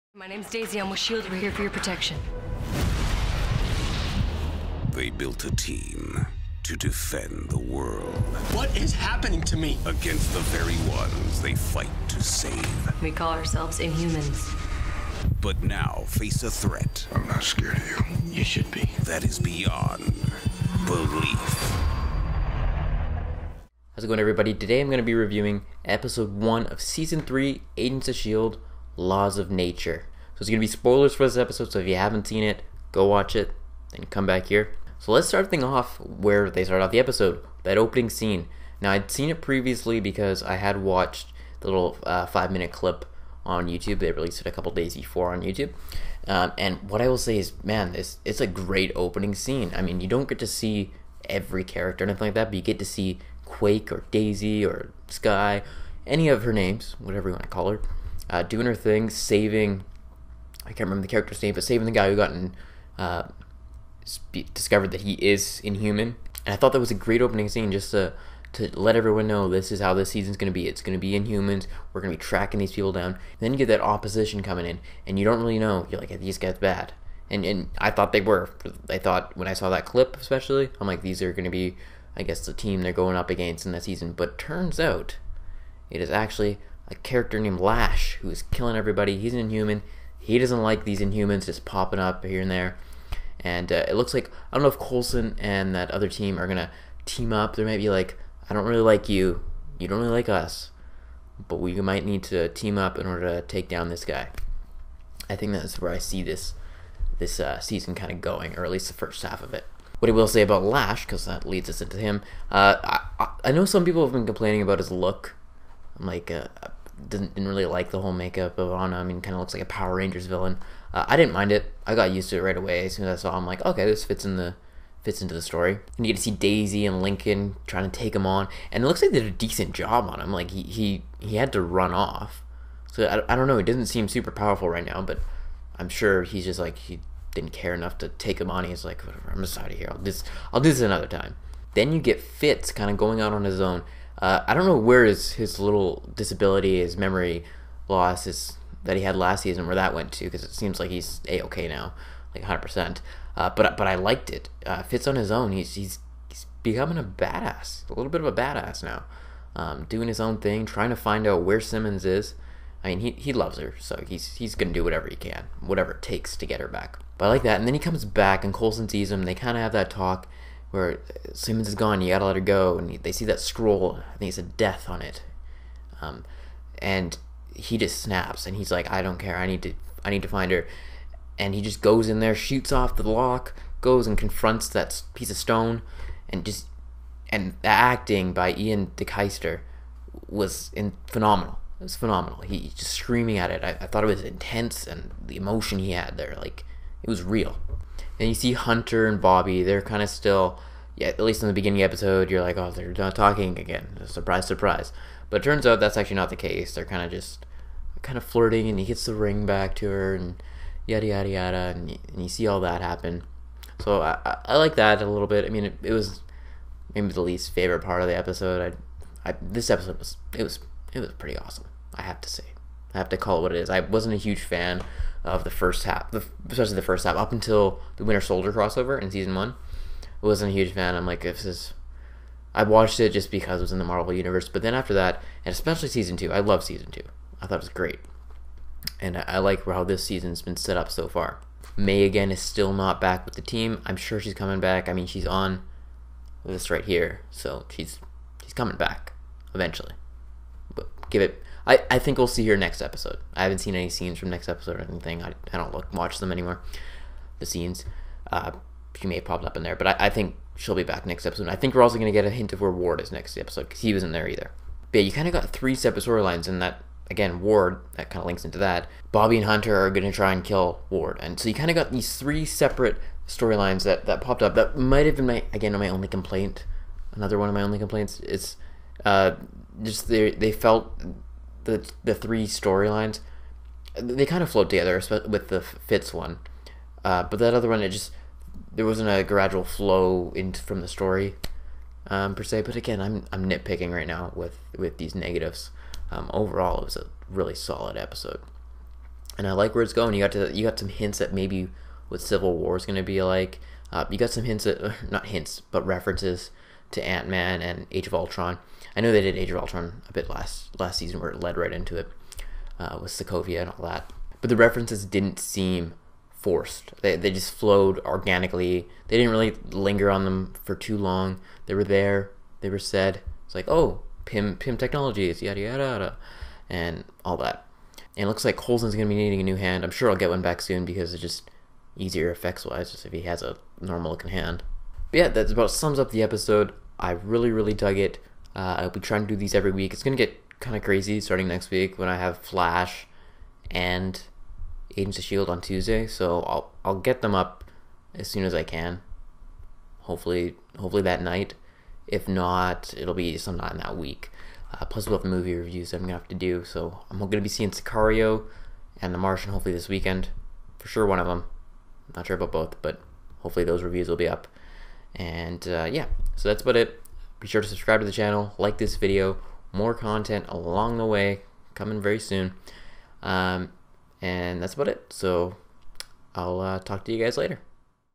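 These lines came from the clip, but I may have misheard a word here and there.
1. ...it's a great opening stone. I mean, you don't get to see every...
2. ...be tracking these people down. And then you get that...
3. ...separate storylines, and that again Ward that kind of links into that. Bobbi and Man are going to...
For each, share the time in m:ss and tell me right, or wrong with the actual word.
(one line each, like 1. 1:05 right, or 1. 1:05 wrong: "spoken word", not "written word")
1. 0:48 wrong: "scene", not "stone"
2. 1:12 right
3. 4:25 wrong: "Hunter", not "Man".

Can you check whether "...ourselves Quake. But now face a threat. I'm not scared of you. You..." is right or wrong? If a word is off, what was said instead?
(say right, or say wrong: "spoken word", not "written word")
wrong: "Inhumans", not "Quake".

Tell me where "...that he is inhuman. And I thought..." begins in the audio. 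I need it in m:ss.
1:04.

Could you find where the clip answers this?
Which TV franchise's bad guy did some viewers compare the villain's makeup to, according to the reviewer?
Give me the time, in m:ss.
1:59.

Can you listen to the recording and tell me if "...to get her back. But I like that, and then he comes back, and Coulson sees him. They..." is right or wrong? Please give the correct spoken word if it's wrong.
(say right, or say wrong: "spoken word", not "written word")
right.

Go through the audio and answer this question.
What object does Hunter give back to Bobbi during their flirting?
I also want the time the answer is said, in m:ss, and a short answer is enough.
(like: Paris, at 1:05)
The ring, at 3:29.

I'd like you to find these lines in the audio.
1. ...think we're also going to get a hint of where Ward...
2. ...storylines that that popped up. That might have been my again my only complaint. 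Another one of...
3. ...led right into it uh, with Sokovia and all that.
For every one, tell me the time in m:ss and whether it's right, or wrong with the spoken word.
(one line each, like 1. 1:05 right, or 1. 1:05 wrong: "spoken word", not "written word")
1. 4:21 right
2. 4:33 right
3. 5:11 right.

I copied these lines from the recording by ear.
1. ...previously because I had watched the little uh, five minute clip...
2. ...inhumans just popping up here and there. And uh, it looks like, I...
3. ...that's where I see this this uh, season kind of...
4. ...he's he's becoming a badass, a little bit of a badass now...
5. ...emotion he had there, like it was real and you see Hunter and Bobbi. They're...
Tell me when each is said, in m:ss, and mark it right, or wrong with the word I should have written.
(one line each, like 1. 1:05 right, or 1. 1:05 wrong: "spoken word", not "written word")
1. 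0:39 right
2. 1:30 right
3. 1:45 right
4. 2:35 right
5. 3:15 right.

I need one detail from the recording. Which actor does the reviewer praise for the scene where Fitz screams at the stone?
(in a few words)
Ian DeKeister.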